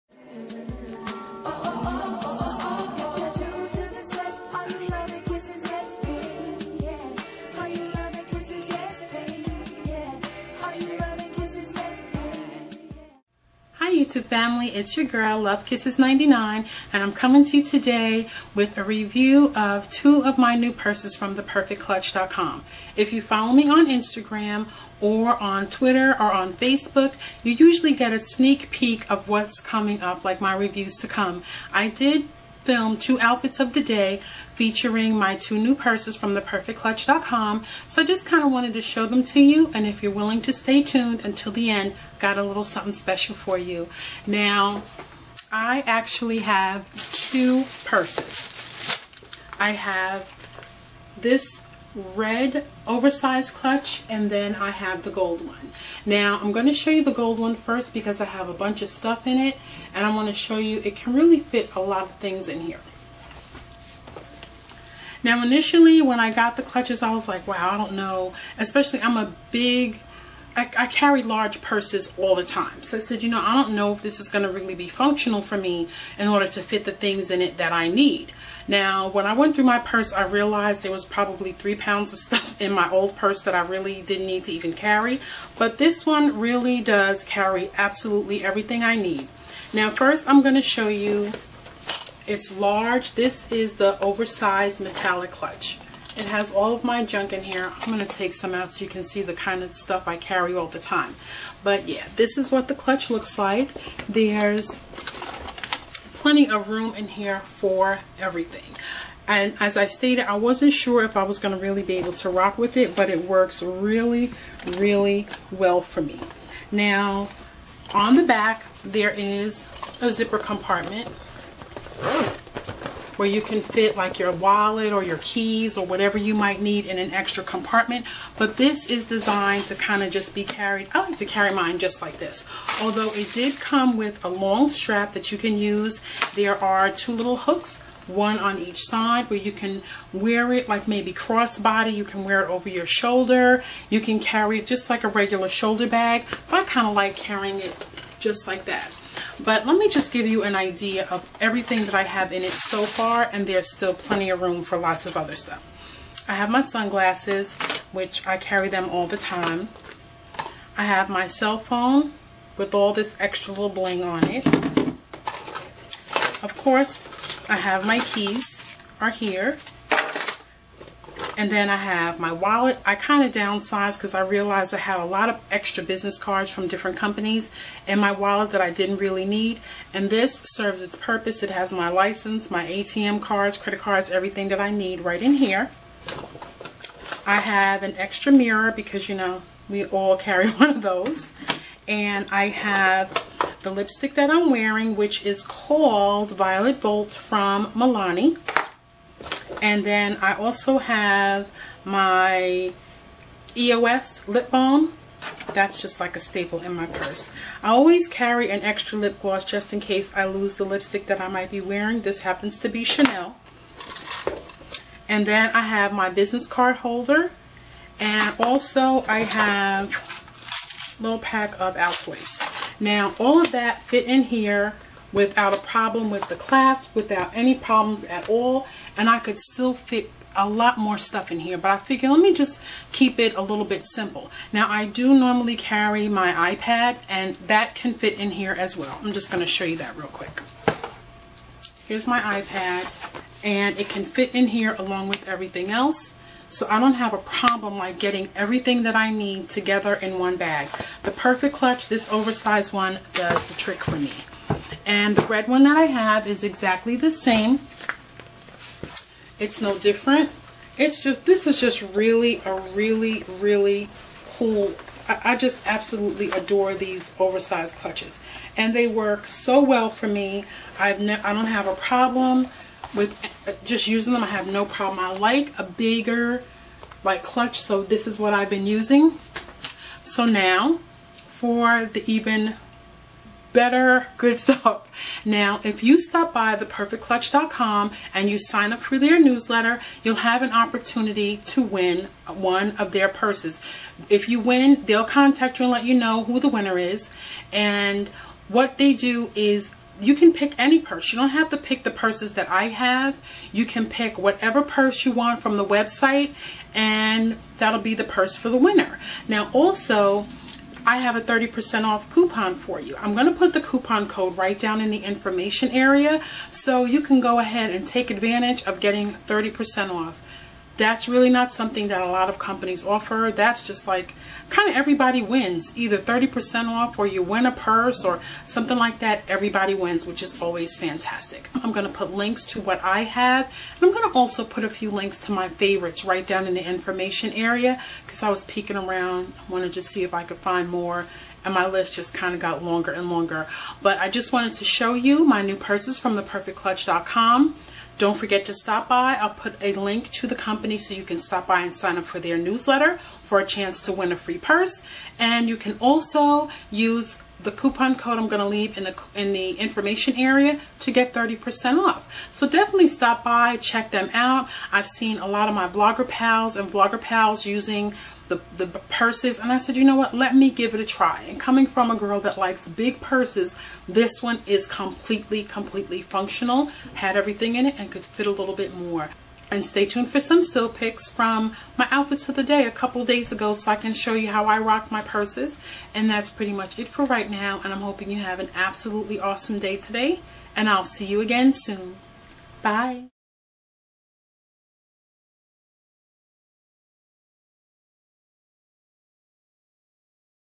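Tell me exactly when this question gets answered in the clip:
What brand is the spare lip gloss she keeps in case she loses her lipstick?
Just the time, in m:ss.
3:32.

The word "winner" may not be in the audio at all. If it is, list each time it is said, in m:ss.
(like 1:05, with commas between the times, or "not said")
4:56, 5:08.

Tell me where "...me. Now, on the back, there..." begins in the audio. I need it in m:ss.
1:56.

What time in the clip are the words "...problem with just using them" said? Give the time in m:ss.
4:31.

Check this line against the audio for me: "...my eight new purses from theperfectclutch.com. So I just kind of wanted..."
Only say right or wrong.
wrong.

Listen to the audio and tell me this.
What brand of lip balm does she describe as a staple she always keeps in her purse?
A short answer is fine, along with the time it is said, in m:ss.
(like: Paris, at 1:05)
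EOS, at 3:23.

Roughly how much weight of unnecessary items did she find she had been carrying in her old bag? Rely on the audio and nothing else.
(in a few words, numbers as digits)
3 pounds.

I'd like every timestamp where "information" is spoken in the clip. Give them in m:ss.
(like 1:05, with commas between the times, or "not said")
5:15, 5:36, 5:59.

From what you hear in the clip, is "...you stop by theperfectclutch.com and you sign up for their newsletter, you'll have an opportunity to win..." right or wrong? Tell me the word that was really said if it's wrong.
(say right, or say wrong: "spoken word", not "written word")
right.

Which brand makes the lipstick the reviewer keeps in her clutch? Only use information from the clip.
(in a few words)
Milani.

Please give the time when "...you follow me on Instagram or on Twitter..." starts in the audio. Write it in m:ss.
0:23.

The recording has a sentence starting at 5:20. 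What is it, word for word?
That's really not something that a lot of companies offer.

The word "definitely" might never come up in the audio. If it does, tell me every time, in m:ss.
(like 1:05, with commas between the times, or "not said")
6:02.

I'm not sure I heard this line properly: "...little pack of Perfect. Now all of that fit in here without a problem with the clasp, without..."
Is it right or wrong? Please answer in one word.
wrong.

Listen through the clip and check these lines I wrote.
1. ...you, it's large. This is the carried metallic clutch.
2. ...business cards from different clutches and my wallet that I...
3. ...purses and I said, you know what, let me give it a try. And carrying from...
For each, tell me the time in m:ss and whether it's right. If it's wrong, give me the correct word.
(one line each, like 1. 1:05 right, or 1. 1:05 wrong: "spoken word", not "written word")
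1. 1:30 wrong: "oversized", not "carried"
2. 2:55 wrong: "companies", not "clutches"
3. 6:08 wrong: "coming", not "carrying".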